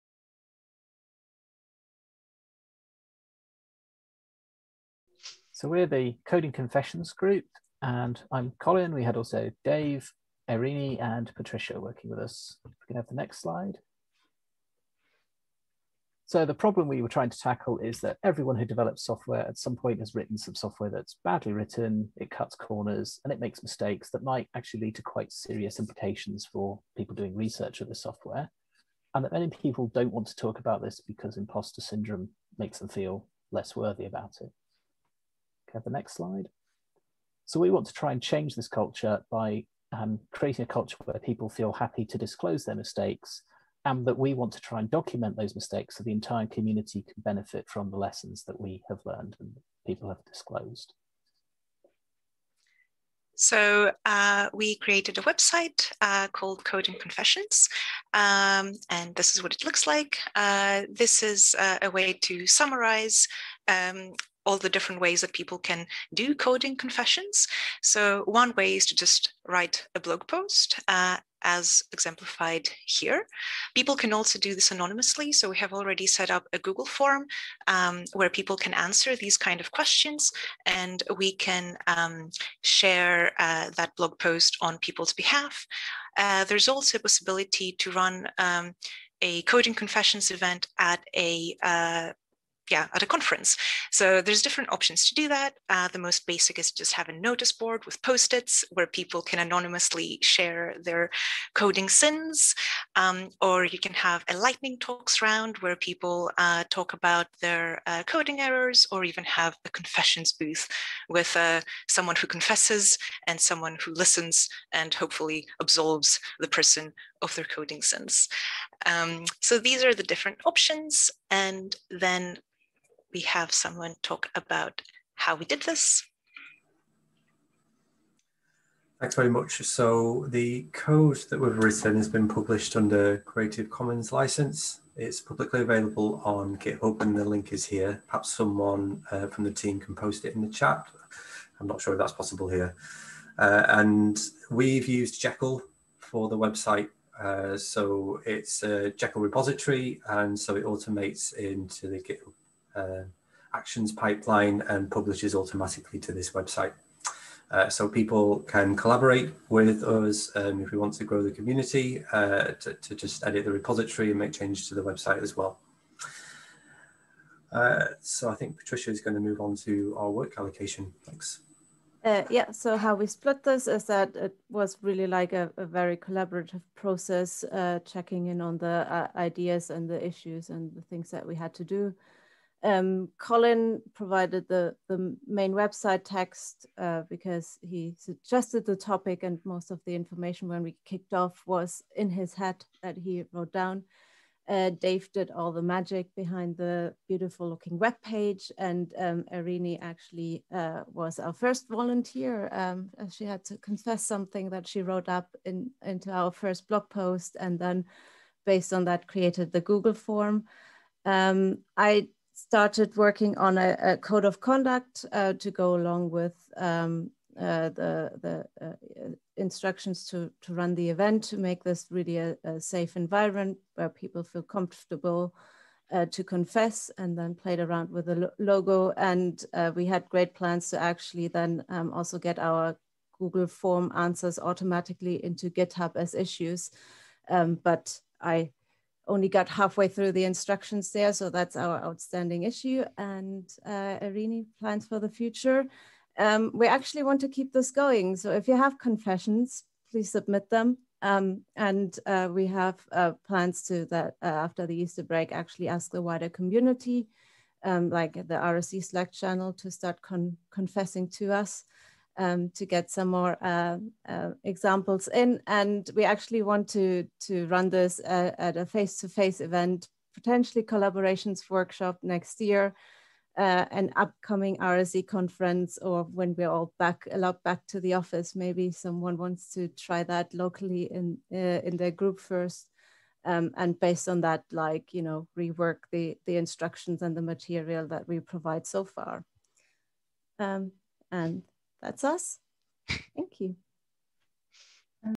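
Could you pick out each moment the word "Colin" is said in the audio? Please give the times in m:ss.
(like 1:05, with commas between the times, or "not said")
0:08, 3:03.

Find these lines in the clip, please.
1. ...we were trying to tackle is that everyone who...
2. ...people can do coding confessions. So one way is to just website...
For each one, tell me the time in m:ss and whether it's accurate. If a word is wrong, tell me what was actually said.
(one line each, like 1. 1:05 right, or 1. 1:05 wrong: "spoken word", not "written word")
1. 0:16 right
2. 1:05 wrong: "write", not "website".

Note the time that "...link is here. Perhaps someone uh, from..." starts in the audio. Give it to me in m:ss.
2:17.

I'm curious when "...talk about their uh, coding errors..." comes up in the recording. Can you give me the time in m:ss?
1:46.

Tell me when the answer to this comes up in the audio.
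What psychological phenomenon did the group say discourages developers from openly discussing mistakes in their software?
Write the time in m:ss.
0:31.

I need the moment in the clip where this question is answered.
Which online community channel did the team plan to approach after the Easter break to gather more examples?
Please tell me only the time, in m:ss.
4:18.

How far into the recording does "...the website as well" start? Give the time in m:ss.
2:44.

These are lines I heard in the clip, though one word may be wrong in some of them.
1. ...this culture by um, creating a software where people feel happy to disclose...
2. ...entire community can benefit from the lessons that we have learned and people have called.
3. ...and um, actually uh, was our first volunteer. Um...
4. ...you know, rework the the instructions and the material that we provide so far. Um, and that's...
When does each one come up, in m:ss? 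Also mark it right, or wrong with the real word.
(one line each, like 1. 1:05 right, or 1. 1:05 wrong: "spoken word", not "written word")
1. 0:38 wrong: "culture", not "software"
2. 0:46 wrong: "disclosed", not "called"
3. 3:18 right
4. 4:44 right.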